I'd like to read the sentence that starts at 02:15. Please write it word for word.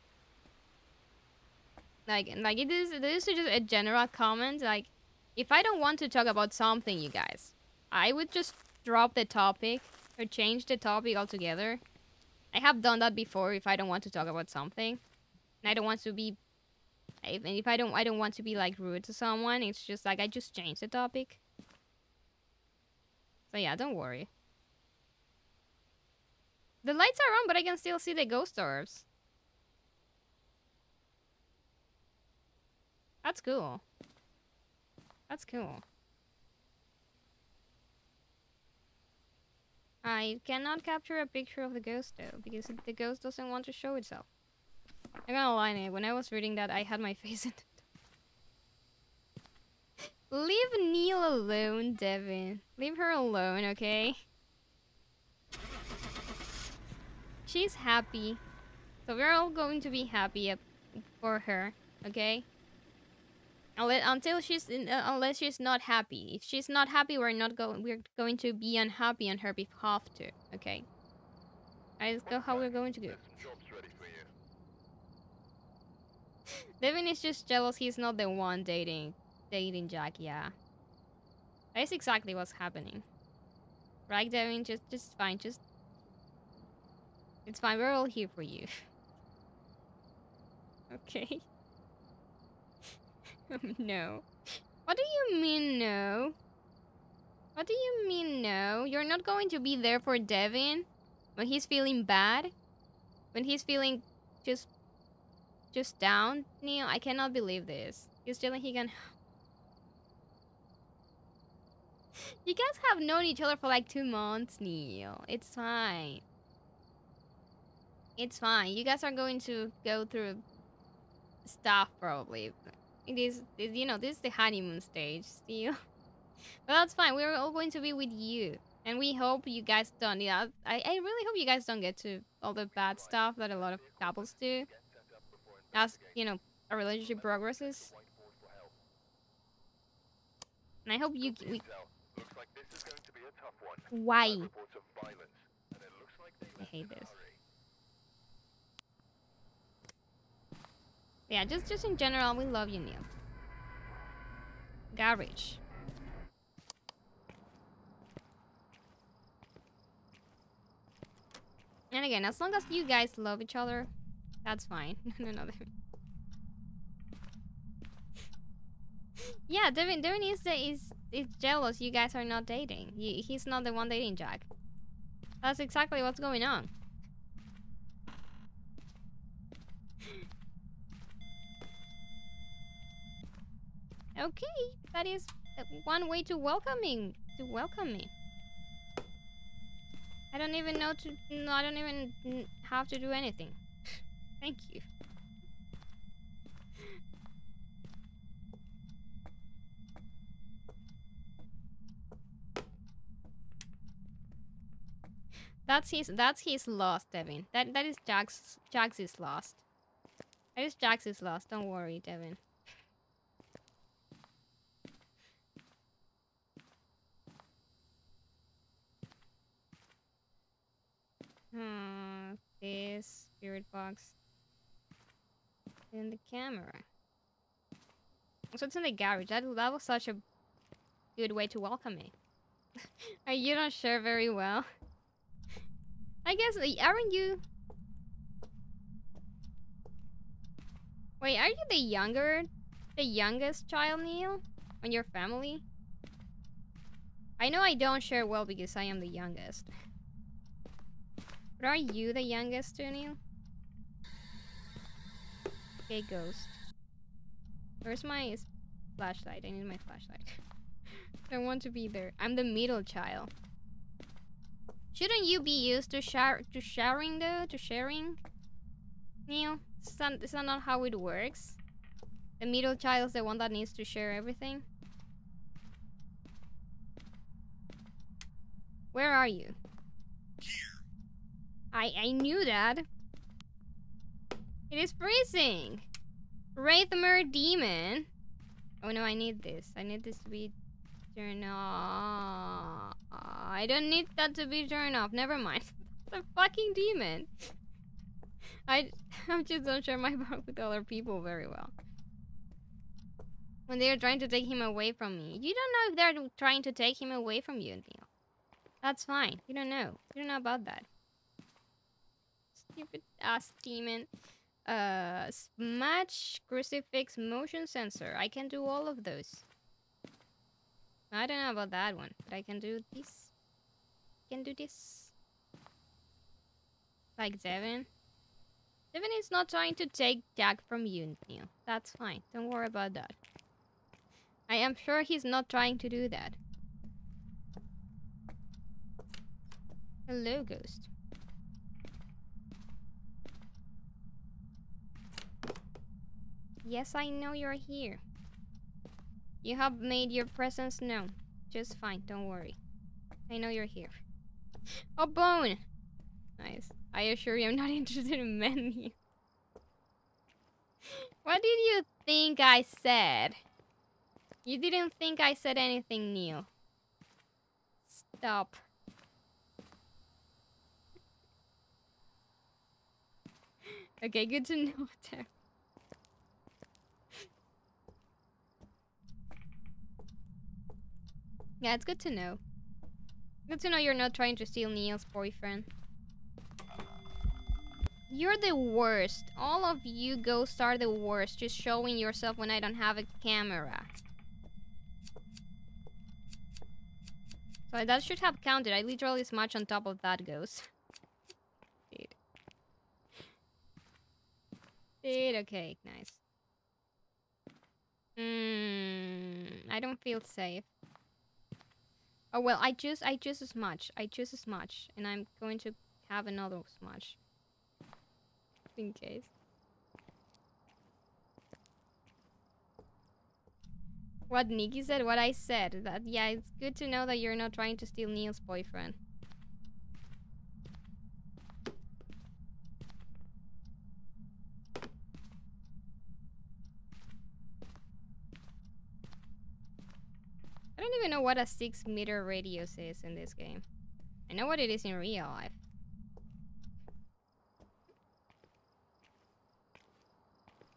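As, you know, a relationship progresses.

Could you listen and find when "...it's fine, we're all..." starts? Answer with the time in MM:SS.
01:27.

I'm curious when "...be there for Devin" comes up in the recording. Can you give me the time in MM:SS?
01:39.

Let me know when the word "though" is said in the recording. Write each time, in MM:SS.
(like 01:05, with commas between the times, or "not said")
00:42, 04:27.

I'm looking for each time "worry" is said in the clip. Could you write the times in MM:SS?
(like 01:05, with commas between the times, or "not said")
00:23, 03:31, 05:32, 05:52.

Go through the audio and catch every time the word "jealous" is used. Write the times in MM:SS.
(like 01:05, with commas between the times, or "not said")
01:17, 02:51.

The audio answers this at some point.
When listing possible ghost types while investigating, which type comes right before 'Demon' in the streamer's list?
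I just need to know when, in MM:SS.
04:46.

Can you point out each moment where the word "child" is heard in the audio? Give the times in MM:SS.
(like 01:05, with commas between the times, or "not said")
04:03, 04:22, 04:32.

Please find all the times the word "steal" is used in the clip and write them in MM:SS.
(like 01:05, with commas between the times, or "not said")
06:24, 07:07.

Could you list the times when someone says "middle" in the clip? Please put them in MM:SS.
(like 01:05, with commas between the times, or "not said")
04:22, 04:32.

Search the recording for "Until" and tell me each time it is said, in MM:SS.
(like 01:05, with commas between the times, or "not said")
01:03.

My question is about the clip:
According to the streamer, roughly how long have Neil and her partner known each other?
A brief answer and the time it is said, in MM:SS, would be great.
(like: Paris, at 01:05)
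two months, at 01:53.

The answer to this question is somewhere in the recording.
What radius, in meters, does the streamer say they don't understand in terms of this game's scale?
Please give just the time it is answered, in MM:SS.
07:21.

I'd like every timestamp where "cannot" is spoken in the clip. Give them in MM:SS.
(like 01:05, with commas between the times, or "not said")
00:40, 01:46.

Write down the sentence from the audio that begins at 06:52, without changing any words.
Oh well, I just I just as much.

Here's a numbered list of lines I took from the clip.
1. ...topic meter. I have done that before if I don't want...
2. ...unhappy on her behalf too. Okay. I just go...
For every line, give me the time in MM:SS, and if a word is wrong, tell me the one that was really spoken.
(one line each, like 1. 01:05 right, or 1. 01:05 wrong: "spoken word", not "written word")
1. 00:10 wrong: "altogether", not "meter"
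2. 01:08 right.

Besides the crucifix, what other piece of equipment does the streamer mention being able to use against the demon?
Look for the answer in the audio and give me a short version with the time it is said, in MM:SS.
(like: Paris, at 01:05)
motion sensor, at 05:17.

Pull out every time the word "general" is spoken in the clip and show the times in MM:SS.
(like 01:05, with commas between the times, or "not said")
00:03, 02:31.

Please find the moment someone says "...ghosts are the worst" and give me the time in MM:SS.
06:30.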